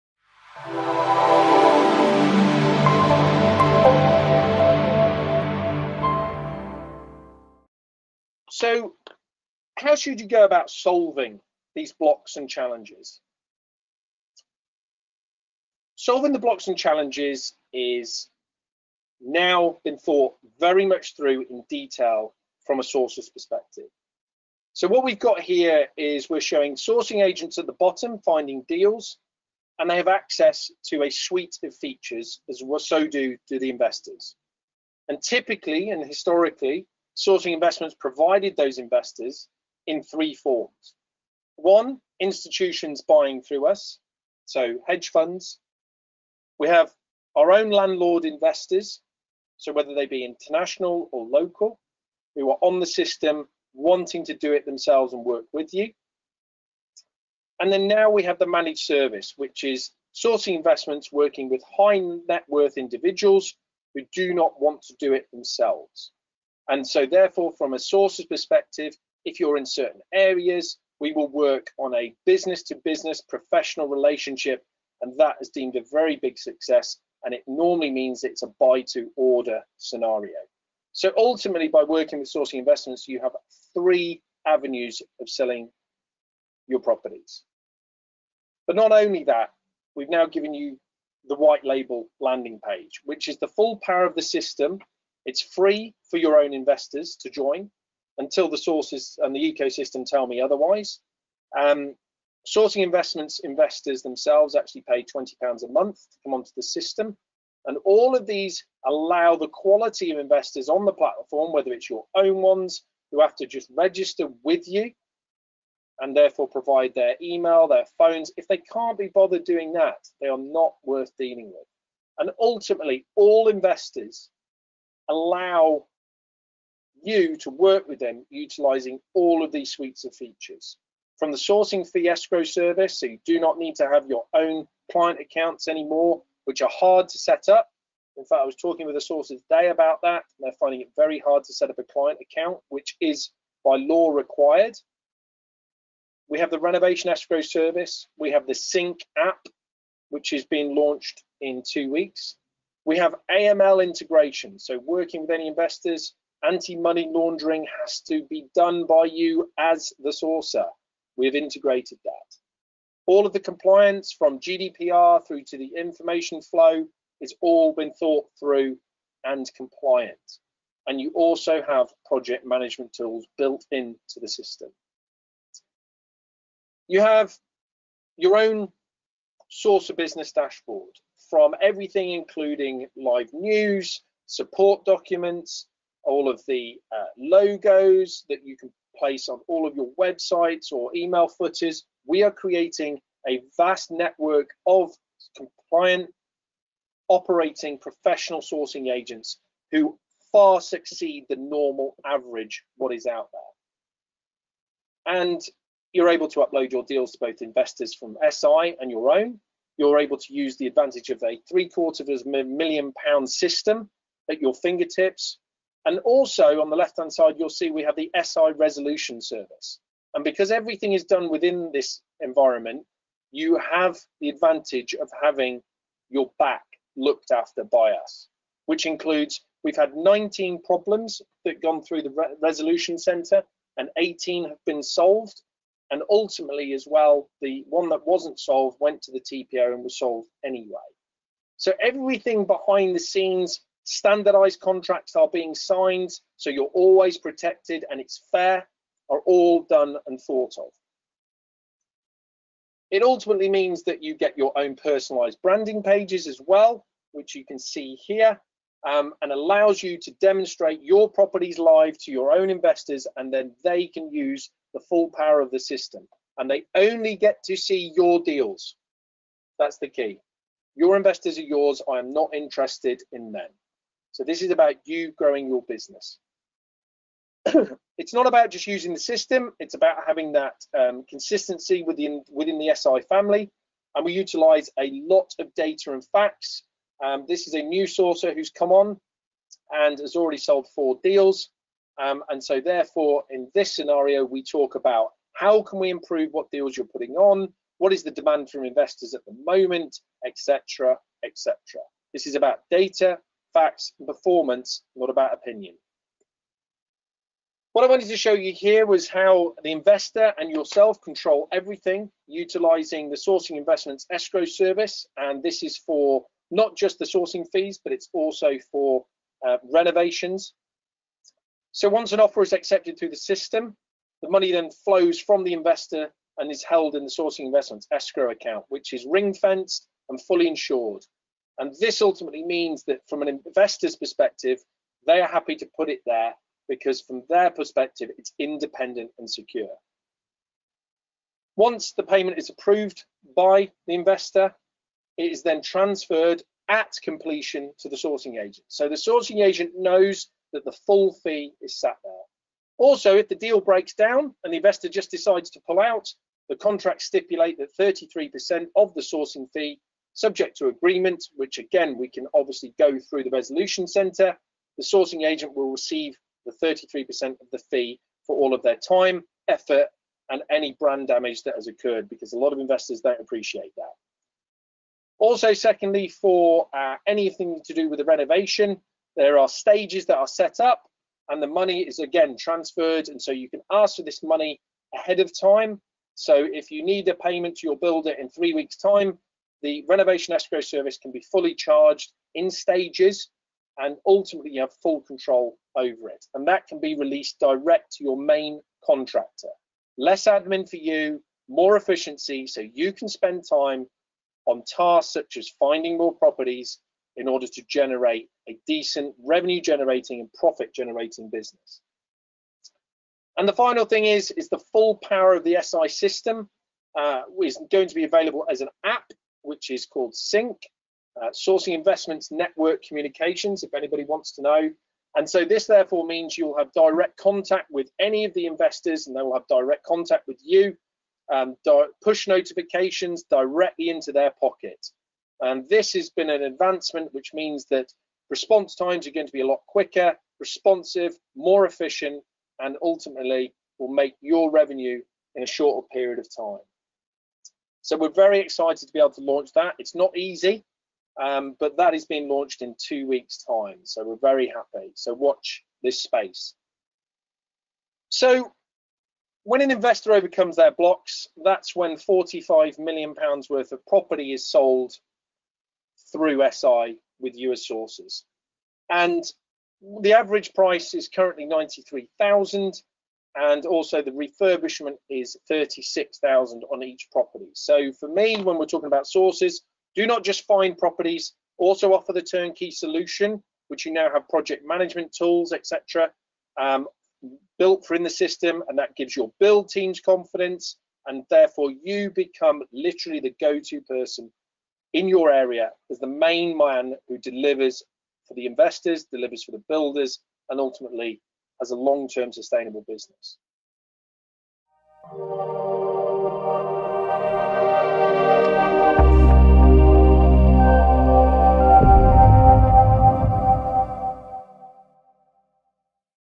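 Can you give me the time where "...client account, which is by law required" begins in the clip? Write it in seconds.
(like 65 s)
141 s.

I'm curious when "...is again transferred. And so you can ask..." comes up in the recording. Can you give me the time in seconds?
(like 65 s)
381 s.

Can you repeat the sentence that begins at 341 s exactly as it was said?
Once the payment is approved by the investor, it is then transferred at completion to the sourcing agent.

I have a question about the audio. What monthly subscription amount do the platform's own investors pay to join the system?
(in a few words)
£20.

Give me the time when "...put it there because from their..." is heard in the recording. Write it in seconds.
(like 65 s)
335 s.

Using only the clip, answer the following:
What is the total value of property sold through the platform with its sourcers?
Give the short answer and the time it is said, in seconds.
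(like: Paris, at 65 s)
£45 million, at 461 s.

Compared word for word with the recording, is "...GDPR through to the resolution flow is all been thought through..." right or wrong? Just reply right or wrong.
wrong.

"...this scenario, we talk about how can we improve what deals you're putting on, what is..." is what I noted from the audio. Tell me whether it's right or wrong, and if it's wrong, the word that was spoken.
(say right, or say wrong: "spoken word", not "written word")
right.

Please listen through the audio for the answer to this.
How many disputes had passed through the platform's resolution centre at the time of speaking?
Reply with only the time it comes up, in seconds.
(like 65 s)
229 s.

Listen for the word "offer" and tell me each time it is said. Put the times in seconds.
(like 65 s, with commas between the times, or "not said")
322 s, 481 s.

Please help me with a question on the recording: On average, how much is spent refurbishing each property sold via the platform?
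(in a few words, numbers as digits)
36,000.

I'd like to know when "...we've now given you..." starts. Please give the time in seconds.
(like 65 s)
89 s.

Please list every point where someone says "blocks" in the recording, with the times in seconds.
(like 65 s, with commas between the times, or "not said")
11 s, 16 s, 460 s.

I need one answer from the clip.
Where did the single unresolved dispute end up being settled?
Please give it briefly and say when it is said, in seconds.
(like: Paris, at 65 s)
The TPO, at 239 s.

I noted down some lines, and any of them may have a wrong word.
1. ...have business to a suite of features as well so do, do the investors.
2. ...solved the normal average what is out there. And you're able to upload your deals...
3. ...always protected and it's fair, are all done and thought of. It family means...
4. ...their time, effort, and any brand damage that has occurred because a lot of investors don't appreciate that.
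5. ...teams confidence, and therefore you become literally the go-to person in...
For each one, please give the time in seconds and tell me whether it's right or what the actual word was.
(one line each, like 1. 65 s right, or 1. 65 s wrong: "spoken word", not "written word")
1. 29 s wrong: "access", not "business"
2. 200 s wrong: "succeed", not "solved"
3. 246 s wrong: "ultimately", not "family"
4. 368 s right
5. 489 s right.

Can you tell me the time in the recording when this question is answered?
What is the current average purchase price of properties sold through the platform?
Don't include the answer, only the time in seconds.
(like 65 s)
471 s.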